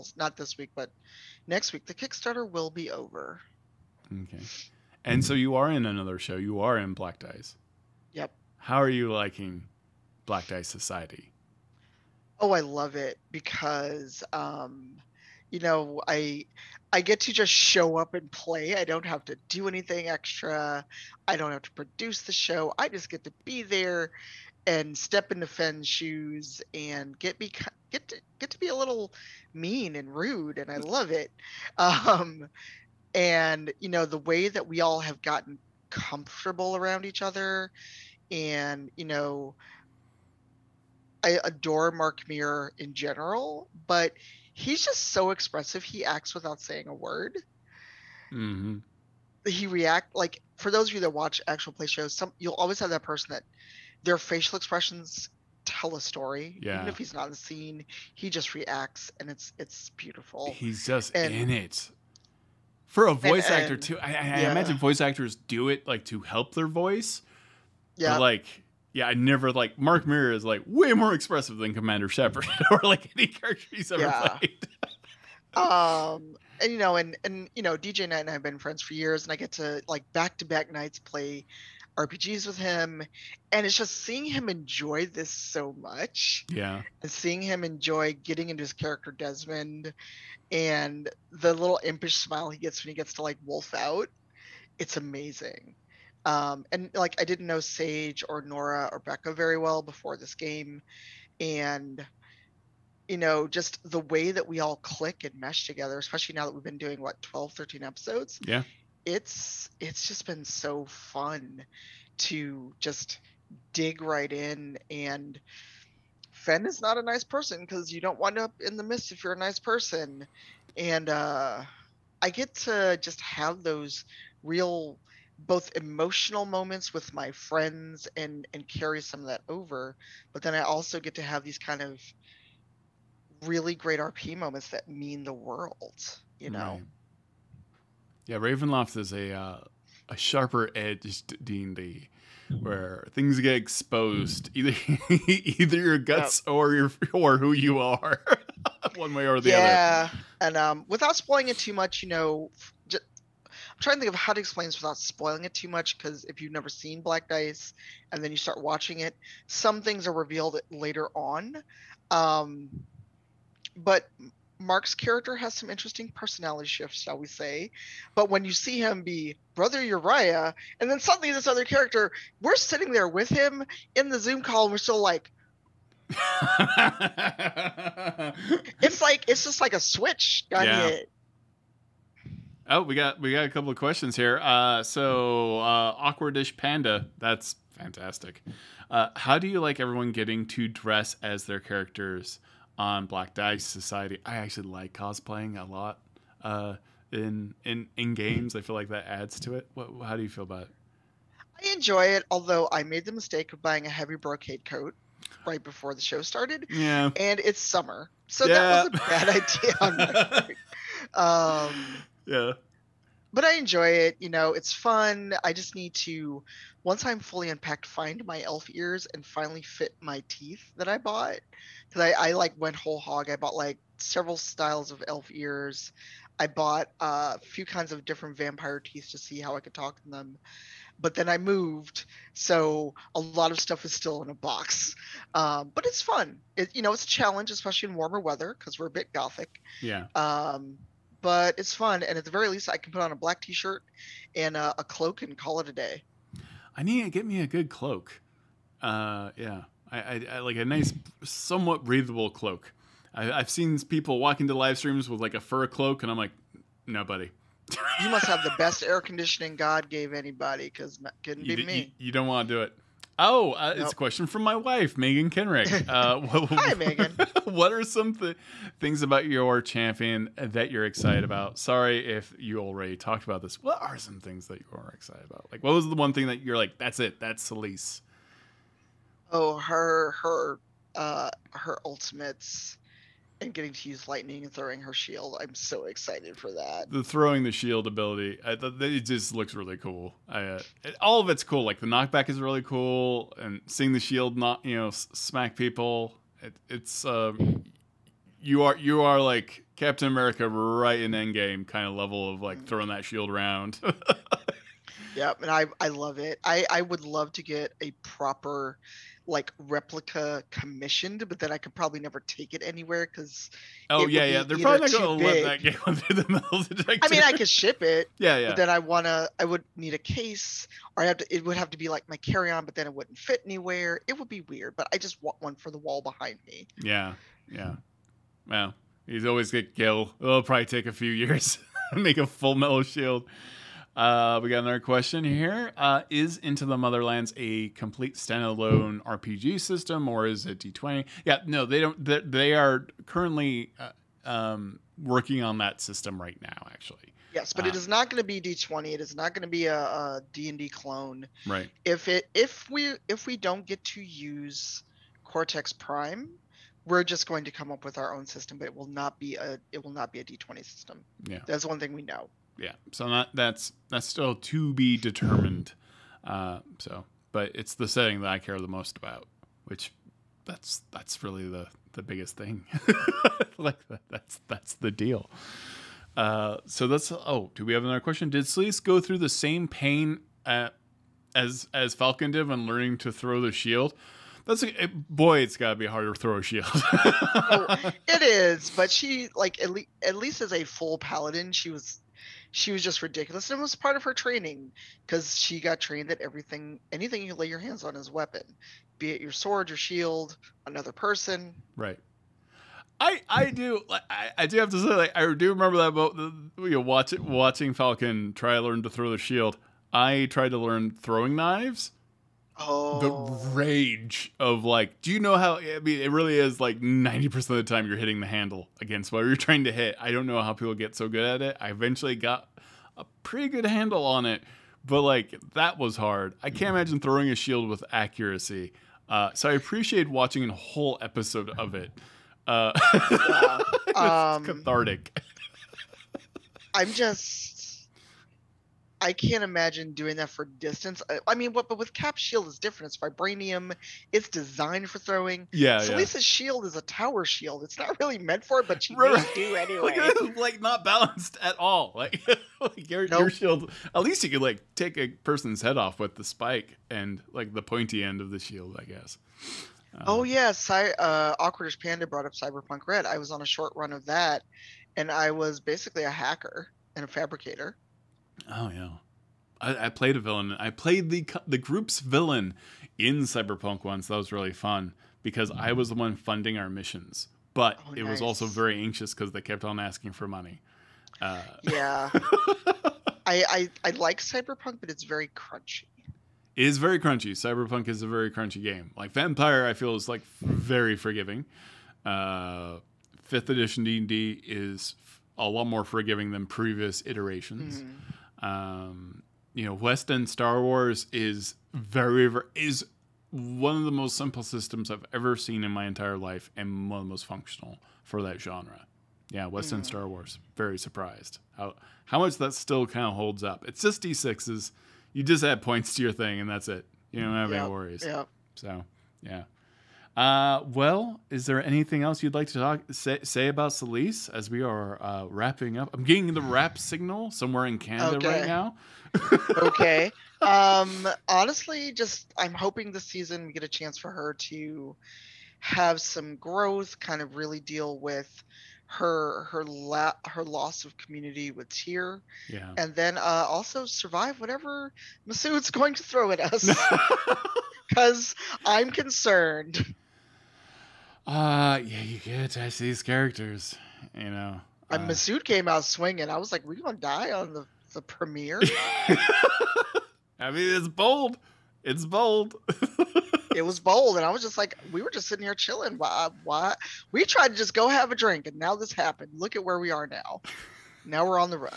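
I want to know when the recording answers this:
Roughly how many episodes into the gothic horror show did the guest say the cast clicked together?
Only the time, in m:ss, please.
1:47.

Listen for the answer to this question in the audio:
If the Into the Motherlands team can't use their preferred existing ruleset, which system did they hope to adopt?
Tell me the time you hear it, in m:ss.
5:55.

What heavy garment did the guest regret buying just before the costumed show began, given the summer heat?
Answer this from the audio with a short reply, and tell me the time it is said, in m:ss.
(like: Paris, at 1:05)
brocade coat, at 3:24.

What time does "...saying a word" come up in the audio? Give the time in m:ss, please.
0:46.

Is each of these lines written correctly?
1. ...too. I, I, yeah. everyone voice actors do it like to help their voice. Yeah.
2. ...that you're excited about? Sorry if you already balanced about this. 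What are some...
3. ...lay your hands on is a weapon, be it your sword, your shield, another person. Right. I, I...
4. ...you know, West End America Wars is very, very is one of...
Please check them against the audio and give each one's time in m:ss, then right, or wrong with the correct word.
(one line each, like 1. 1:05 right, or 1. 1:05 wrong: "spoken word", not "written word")
1. 1:03 wrong: "imagine", not "everyone"
2. 4:30 wrong: "talked", not "balanced"
3. 6:37 right
4. 8:19 wrong: "Star", not "America".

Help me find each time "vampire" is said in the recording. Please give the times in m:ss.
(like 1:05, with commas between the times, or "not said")
3:48, 8:09.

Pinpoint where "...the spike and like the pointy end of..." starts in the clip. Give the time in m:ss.
7:36.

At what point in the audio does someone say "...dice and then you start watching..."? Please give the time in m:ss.
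2:37.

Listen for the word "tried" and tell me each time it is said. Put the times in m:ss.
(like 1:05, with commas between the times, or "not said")
6:50, 9:27.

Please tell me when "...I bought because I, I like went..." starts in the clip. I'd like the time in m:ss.
3:40.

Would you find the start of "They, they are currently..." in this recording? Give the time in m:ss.
5:42.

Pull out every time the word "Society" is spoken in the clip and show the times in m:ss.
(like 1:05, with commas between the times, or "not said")
0:10, 3:13.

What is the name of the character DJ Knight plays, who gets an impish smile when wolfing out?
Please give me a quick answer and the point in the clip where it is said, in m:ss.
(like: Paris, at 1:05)
Desmond, at 1:29.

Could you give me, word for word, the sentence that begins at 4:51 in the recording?
Like the knockback is really cool, and seeing the shield not you know s- smack people.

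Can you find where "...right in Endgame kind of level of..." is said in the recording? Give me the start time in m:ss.
5:00.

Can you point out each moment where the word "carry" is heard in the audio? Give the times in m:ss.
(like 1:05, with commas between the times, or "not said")
2:08, 5:22.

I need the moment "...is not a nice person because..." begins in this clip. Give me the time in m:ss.
1:56.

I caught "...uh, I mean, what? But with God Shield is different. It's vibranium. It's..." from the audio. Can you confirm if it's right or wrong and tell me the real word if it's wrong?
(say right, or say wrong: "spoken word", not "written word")
wrong: "Cap", not "God".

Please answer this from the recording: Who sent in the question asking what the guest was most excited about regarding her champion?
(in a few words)
Megan Kenrick.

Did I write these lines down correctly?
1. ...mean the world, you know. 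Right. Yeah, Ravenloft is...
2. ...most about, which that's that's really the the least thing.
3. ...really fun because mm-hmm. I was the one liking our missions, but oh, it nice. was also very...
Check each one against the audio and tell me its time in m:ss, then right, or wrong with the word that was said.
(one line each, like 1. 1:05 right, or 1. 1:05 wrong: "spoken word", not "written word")
1. 2:14 right
2. 6:08 wrong: "biggest", not "least"
3. 7:54 wrong: "funding", not "liking".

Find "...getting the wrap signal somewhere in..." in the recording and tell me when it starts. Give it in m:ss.
8:46.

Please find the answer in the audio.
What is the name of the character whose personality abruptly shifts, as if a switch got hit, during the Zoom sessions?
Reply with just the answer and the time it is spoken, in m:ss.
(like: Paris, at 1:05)
Brother Uriah, at 2:49.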